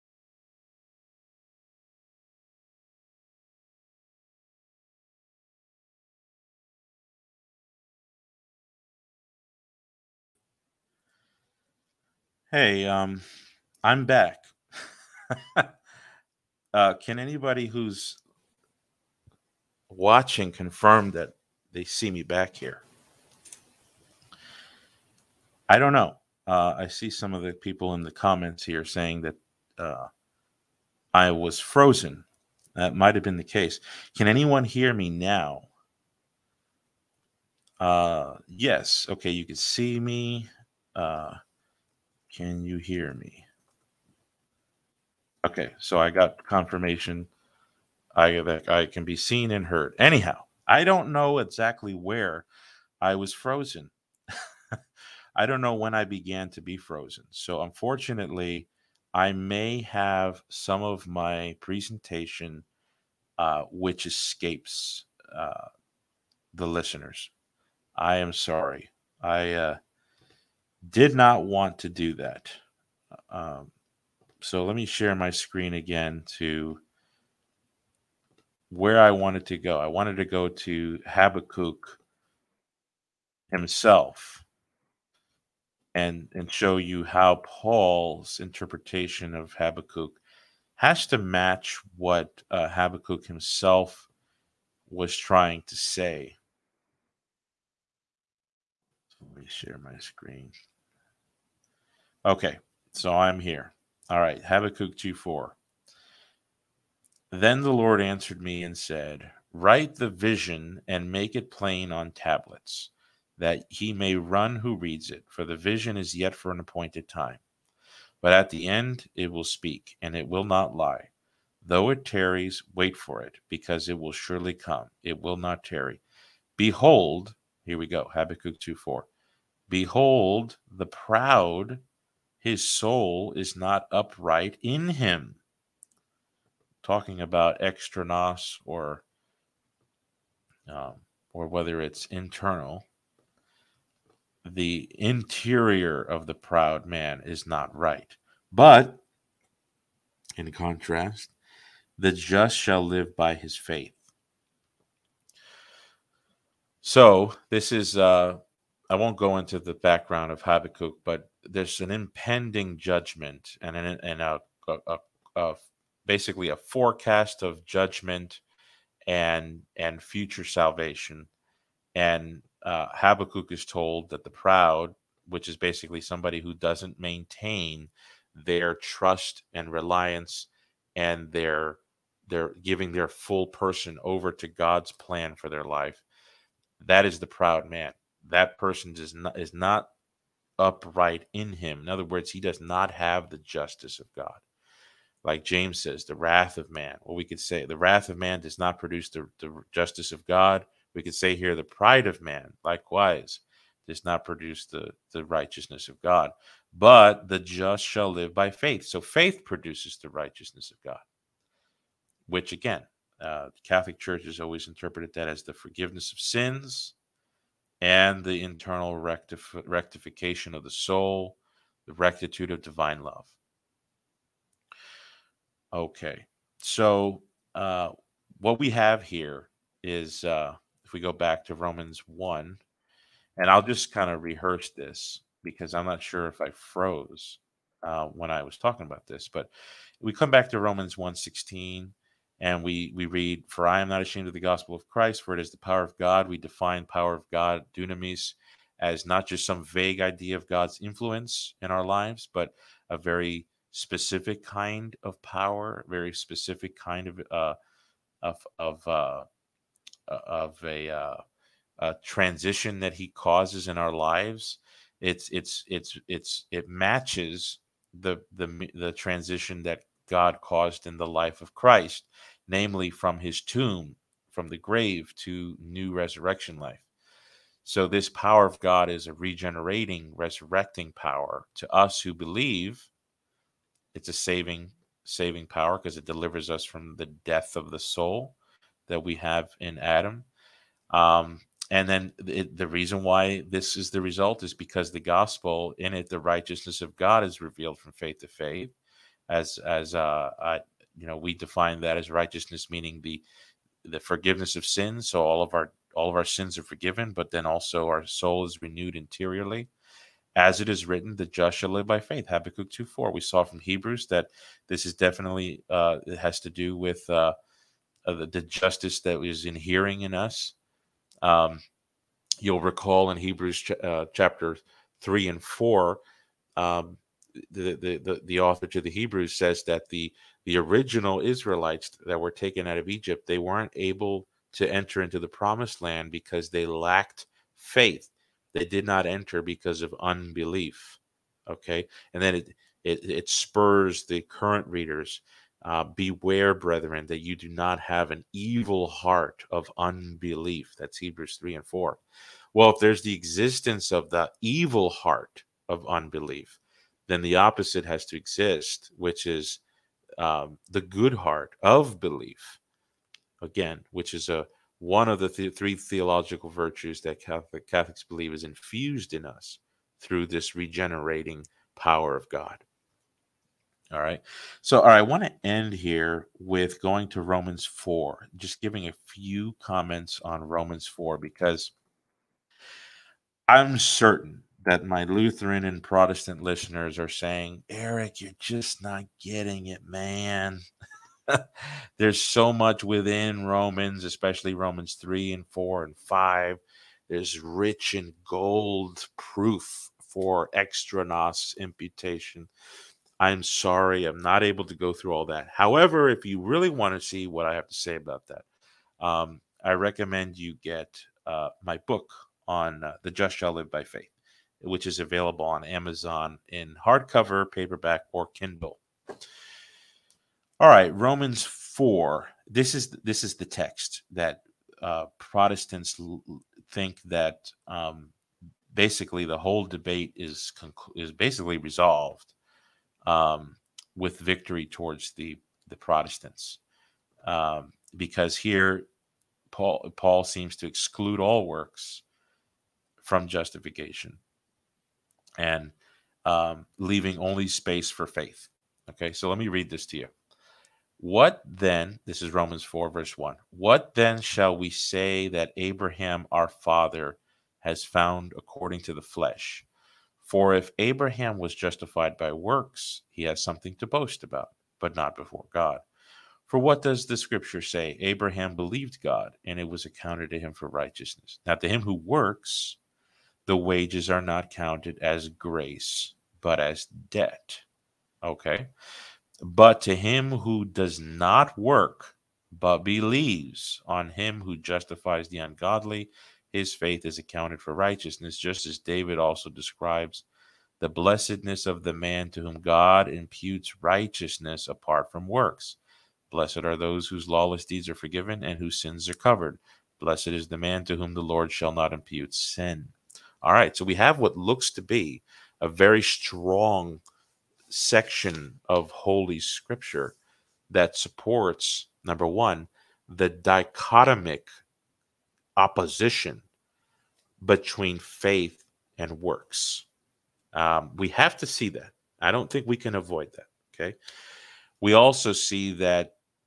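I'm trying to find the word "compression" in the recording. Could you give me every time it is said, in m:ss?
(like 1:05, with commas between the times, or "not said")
not said.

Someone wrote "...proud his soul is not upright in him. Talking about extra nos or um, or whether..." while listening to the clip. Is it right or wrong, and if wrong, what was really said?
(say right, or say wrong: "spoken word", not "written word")
right.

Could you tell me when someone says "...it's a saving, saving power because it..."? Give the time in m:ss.
4:43.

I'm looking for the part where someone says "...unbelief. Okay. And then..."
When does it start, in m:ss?
5:39.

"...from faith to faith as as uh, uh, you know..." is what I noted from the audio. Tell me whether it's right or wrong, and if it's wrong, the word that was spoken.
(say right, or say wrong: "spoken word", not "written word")
right.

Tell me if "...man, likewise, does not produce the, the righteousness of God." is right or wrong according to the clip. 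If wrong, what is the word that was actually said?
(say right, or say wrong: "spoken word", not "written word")
right.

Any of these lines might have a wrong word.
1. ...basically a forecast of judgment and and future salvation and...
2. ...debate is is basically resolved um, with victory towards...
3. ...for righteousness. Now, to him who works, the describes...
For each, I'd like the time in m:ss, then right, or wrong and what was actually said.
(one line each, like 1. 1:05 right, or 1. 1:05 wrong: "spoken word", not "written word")
1. 2:46 right
2. 7:09 right
3. 7:50 wrong: "wages", not "describes".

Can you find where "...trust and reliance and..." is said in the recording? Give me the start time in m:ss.
2:58.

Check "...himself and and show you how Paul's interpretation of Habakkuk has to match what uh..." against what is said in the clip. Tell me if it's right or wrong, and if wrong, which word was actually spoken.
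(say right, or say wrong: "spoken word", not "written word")
right.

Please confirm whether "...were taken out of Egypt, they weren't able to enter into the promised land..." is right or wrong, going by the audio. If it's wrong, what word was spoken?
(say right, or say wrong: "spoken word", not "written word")
right.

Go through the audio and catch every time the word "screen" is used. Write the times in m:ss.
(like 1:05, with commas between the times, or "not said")
1:15, 1:39.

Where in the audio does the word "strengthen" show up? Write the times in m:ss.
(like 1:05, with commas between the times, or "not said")
not said.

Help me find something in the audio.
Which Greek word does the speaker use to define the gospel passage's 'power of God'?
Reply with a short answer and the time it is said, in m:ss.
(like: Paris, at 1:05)
dunamis, at 4:07.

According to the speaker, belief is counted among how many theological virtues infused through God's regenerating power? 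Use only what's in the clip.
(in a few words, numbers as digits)
3.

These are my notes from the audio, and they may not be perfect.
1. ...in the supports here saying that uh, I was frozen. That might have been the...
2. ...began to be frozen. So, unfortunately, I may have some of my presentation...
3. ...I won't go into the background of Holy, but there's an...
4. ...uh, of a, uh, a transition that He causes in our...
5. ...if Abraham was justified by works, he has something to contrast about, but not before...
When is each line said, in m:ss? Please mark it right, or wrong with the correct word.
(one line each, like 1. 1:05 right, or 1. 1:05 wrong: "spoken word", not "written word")
1. 0:27 wrong: "comments", not "supports"
2. 0:56 right
3. 2:38 wrong: "Habakkuk", not "Holy"
4. 4:18 right
5. 7:40 wrong: "boast", not "contrast".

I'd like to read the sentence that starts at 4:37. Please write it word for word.
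So, this power of God is a regenerating, resurrecting power.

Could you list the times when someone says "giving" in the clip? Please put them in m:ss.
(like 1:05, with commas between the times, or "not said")
3:02, 6:18.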